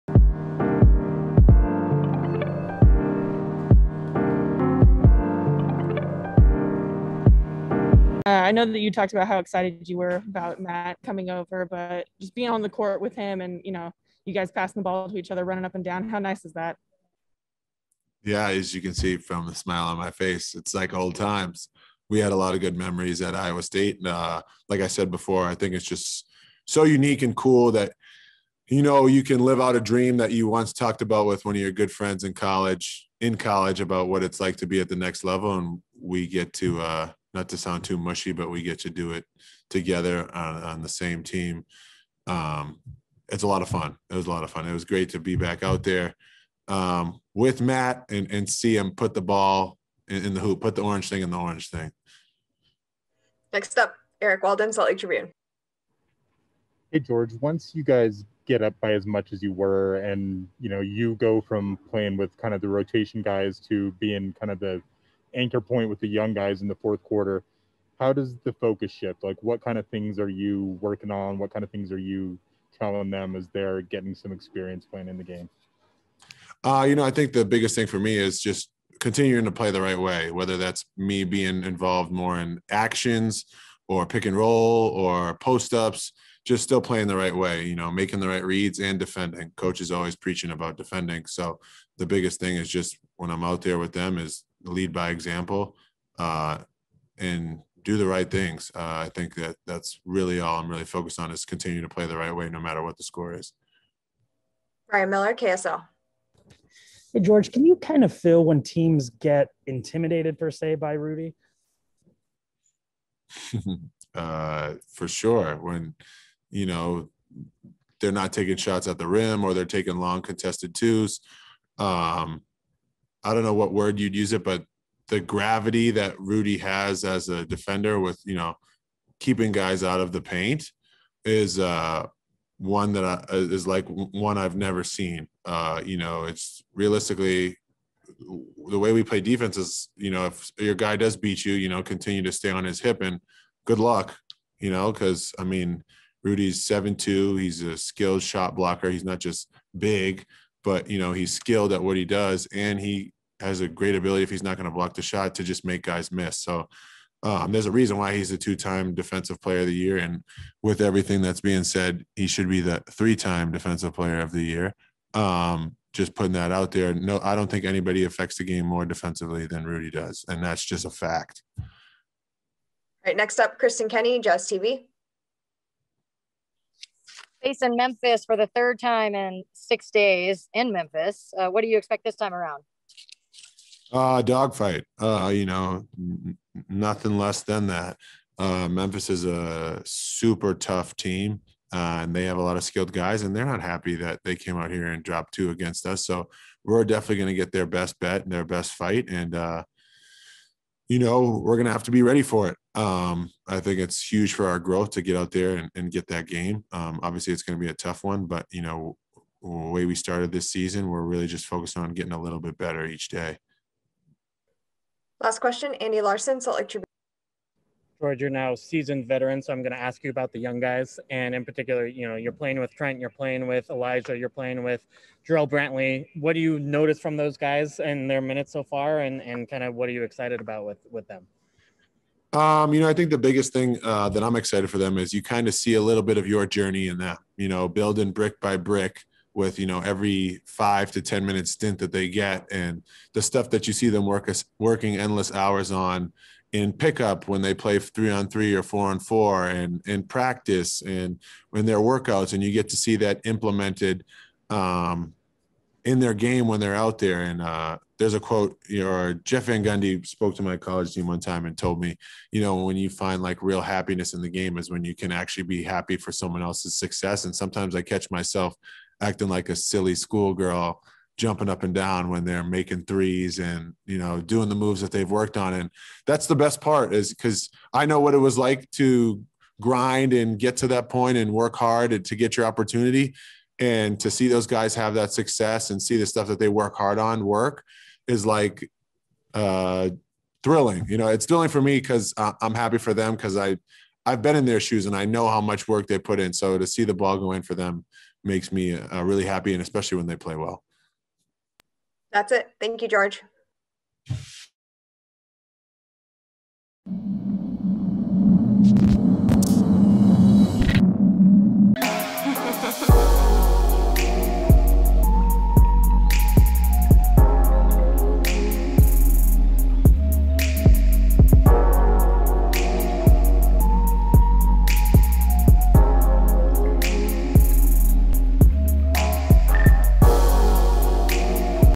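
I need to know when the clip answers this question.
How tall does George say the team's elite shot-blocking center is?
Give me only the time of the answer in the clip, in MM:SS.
02:26.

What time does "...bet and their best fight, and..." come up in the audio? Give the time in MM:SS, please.
03:17.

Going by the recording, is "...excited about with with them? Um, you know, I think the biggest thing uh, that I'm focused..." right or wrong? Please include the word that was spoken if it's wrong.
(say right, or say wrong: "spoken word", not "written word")
wrong: "excited", not "focused".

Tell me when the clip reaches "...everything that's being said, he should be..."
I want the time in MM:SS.
02:40.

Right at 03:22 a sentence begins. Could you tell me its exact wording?
Um, I think it's huge for our growth to get out there and, and get that game.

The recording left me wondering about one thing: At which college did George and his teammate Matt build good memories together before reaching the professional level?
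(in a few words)
Iowa State.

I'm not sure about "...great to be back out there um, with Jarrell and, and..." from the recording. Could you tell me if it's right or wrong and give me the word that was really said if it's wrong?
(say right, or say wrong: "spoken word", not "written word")
wrong: "Matt", not "Jarrell".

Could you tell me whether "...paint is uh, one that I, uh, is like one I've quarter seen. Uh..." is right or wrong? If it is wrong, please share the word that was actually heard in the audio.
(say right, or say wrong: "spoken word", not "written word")
wrong: "never", not "quarter".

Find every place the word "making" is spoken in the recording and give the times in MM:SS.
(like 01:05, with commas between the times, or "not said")
01:27, 04:32.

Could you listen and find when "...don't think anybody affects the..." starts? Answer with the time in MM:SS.
02:47.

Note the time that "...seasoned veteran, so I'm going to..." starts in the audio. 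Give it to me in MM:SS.
03:38.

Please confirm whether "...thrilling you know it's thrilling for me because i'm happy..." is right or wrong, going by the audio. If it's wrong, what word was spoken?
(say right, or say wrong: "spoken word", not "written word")
right.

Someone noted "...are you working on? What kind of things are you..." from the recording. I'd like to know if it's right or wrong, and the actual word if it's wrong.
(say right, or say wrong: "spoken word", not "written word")
right.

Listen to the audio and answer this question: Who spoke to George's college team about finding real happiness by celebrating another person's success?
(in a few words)
Jeff Van Gundy.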